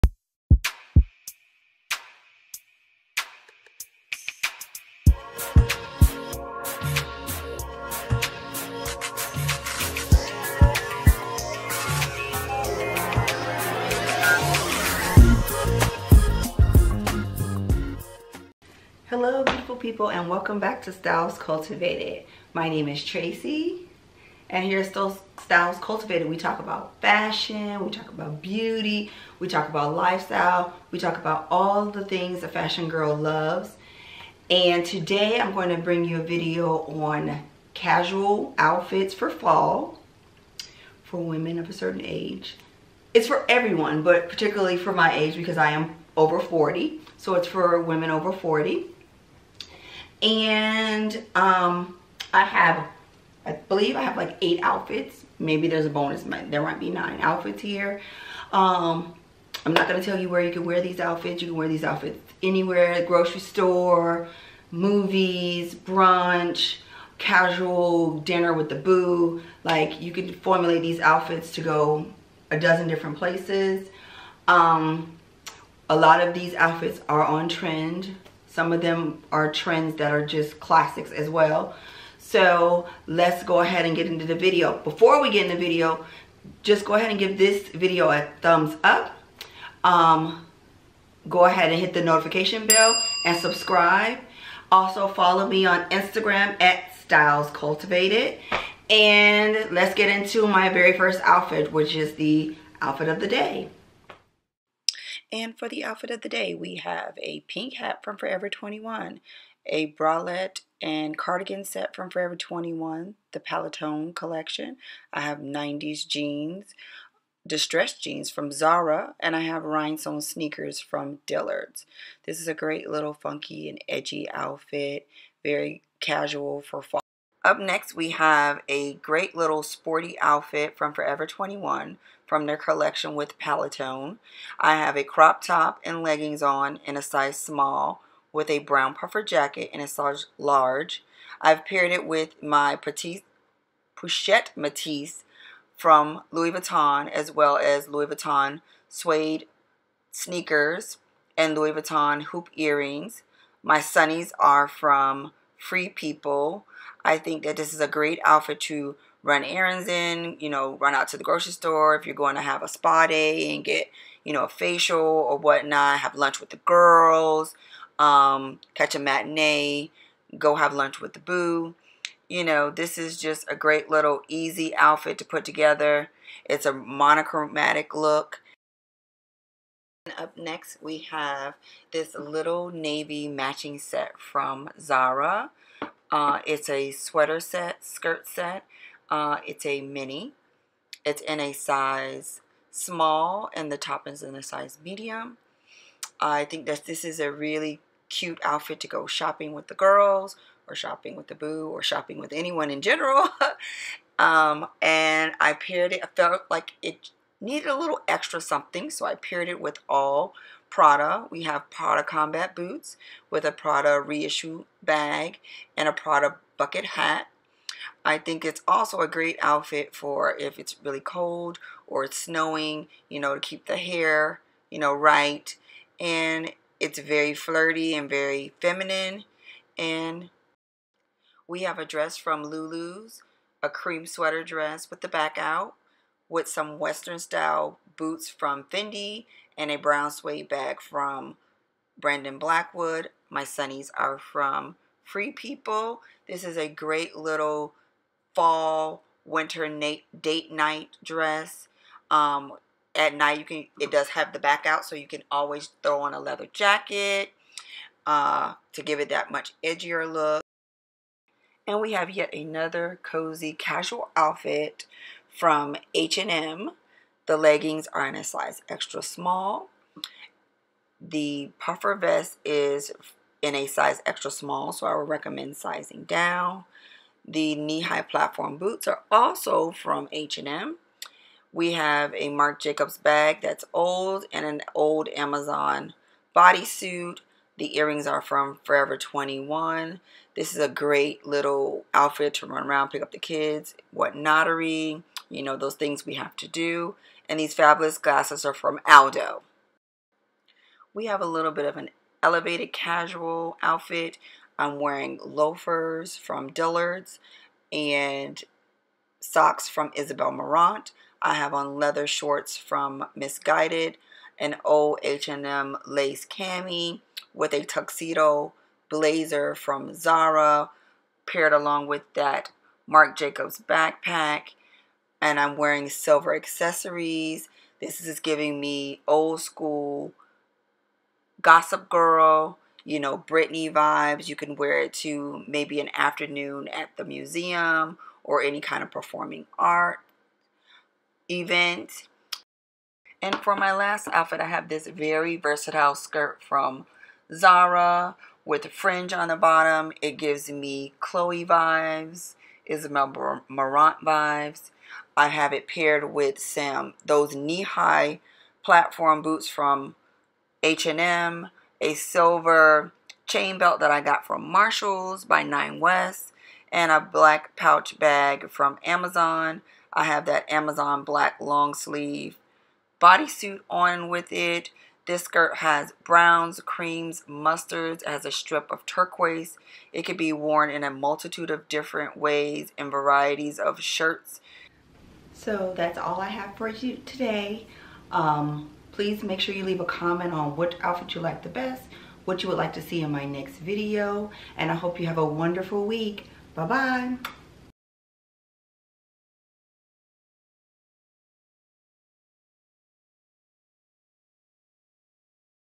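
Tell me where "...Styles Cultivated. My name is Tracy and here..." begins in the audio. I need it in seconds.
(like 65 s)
20 s.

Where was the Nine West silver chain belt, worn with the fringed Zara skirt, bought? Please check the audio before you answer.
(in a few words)
Marshalls.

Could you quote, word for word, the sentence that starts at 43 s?
It's for everyone, but particularly for my age because I am over 40.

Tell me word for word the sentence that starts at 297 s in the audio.
And these fabulous glasses are from Aldo.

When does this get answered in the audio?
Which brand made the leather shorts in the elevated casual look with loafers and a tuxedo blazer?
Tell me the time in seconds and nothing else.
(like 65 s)
313 s.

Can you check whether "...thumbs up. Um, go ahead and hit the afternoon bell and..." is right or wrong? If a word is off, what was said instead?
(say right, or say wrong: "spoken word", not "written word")
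wrong: "notification", not "afternoon".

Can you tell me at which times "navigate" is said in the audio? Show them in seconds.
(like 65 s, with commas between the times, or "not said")
not said.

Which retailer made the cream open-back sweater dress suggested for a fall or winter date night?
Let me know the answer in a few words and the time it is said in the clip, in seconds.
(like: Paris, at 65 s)
Lulu's, at 232 s.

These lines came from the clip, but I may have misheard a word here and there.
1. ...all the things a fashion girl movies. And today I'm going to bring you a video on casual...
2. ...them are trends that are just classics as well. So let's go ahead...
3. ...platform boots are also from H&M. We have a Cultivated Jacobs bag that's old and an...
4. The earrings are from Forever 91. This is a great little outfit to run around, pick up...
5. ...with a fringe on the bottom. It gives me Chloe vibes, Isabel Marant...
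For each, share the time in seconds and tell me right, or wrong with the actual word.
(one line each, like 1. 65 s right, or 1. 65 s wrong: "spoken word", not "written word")
1. 31 s wrong: "loves", not "movies"
2. 78 s right
3. 278 s wrong: "Marc", not "Cultivated"
4. 287 s wrong: "21", not "91"
5. 348 s right.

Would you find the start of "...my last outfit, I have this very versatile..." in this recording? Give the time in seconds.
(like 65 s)
343 s.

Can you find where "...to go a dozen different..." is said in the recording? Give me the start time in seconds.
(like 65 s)
71 s.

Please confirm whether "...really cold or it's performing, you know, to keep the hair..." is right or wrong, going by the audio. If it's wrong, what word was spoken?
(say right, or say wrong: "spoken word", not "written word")
wrong: "snowing", not "performing".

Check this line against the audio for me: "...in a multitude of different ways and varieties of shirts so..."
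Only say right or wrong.
right.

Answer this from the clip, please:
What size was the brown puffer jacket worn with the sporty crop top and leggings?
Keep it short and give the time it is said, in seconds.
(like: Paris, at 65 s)
large, at 139 s.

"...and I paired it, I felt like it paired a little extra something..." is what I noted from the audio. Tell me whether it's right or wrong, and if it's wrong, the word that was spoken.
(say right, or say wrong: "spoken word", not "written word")
wrong: "needed", not "paired".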